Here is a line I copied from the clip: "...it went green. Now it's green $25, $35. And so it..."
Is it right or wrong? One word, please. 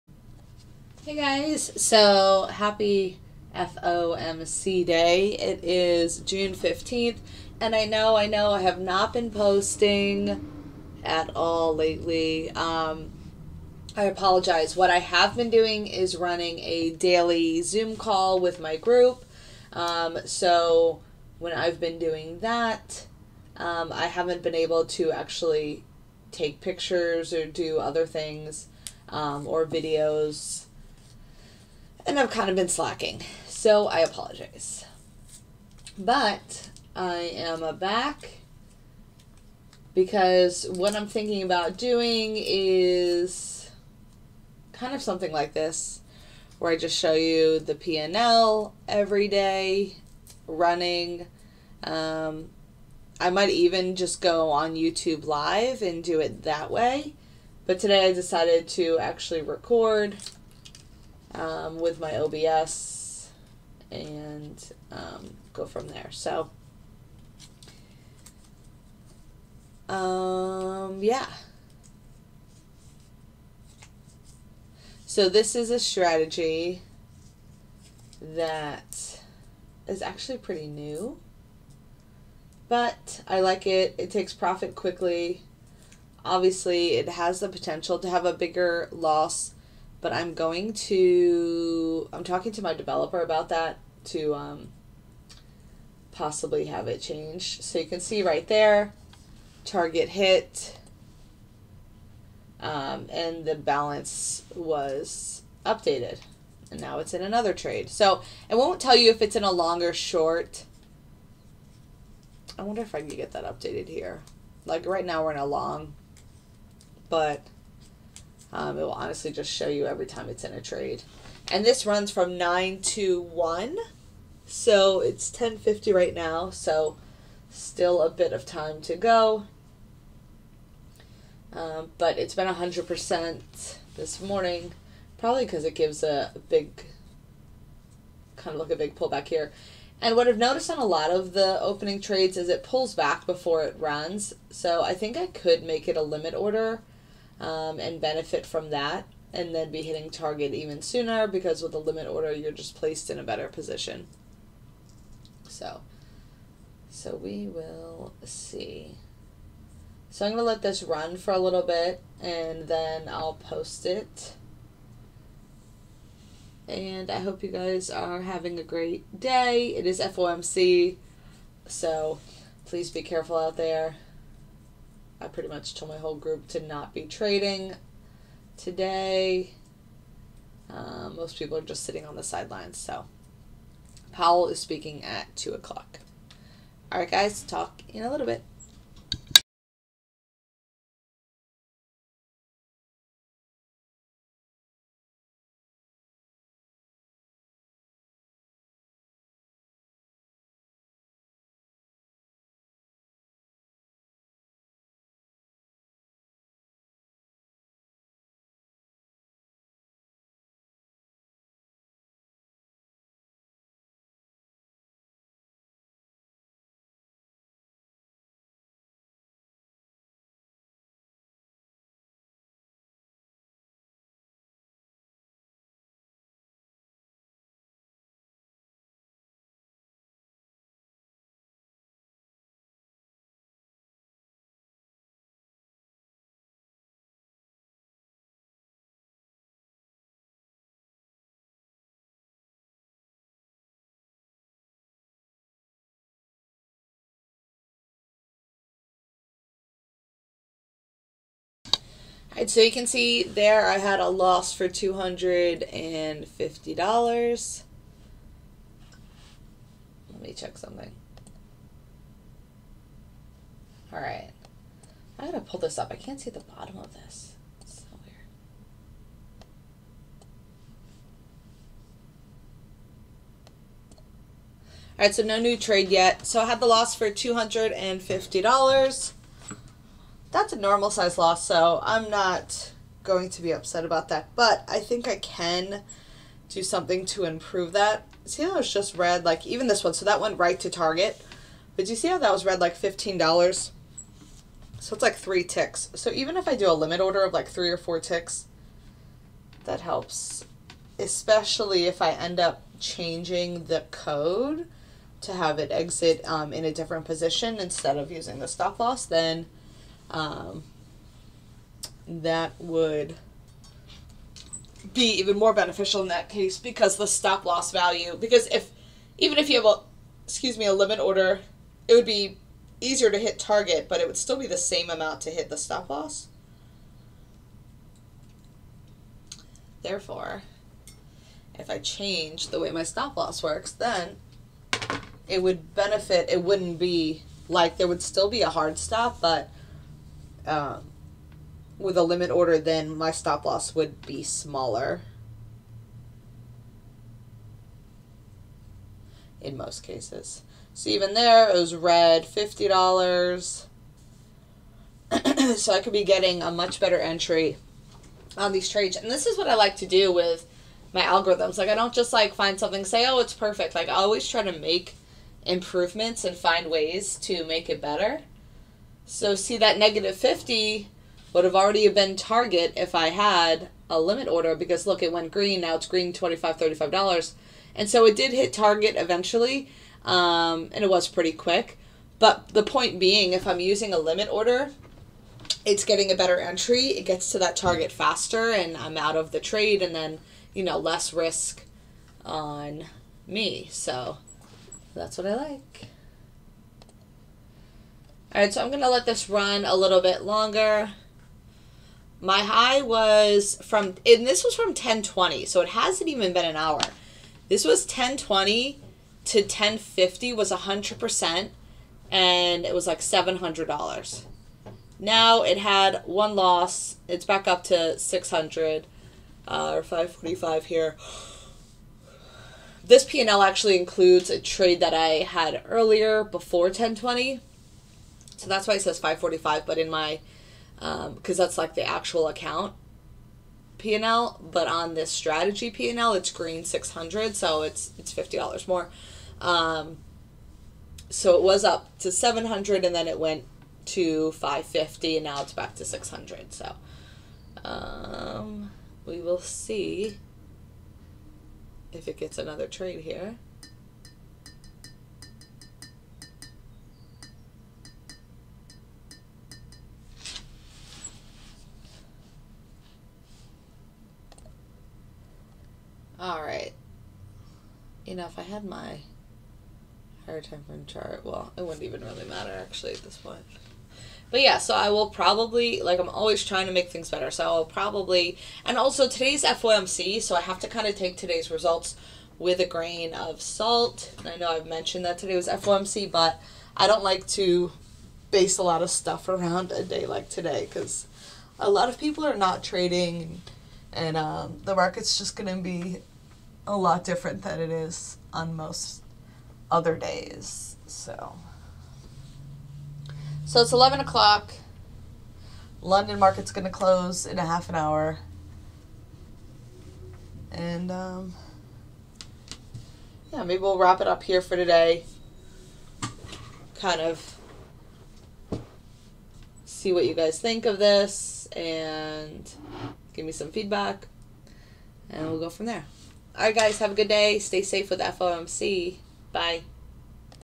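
right.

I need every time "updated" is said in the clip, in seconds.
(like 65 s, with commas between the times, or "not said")
105 s, 113 s.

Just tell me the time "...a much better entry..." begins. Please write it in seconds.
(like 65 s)
356 s.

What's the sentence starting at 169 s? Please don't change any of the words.
It is FOMC, so please be careful out there.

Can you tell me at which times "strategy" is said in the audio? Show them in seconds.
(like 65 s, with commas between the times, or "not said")
75 s, 435 s.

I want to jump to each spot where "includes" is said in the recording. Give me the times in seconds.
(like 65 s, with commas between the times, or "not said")
423 s.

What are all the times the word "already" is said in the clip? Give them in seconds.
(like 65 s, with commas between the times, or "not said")
371 s.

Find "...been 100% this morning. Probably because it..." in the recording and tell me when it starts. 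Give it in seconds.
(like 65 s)
132 s.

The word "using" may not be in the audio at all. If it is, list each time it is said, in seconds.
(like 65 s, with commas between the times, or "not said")
308 s, 383 s.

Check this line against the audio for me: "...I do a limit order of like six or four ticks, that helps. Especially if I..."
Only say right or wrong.
wrong.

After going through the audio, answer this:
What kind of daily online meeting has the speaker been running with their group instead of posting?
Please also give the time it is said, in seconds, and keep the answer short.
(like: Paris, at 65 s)
Zoom call, at 17 s.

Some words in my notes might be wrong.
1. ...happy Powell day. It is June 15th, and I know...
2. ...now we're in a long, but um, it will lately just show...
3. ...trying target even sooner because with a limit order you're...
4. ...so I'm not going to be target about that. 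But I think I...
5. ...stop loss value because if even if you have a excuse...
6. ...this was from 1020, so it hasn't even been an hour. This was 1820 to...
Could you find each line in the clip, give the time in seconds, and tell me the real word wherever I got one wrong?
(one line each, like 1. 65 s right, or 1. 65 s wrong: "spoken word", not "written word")
1. 2 s wrong: "FOMC", not "Powell"
2. 115 s wrong: "honestly", not "lately"
3. 149 s wrong: "hitting", not "trying"
4. 281 s wrong: "upset", not "target"
5. 317 s right
6. 404 s wrong: "1020", not "1820".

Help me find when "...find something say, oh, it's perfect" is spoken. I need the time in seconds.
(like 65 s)
362 s.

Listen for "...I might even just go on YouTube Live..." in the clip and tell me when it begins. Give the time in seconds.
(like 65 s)
53 s.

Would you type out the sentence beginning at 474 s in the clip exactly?
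But yeah, so I will probably, like, I'm always trying to make things better.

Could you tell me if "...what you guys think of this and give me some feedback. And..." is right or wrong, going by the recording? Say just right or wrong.
right.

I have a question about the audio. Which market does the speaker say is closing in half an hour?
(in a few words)
London.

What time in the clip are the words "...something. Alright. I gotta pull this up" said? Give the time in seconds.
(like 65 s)
260 s.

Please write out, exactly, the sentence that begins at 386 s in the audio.
It gets to that target faster, and I'm out of the trade, and then, you know, less risk on me.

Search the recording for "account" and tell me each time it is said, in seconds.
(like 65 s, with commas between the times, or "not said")
432 s.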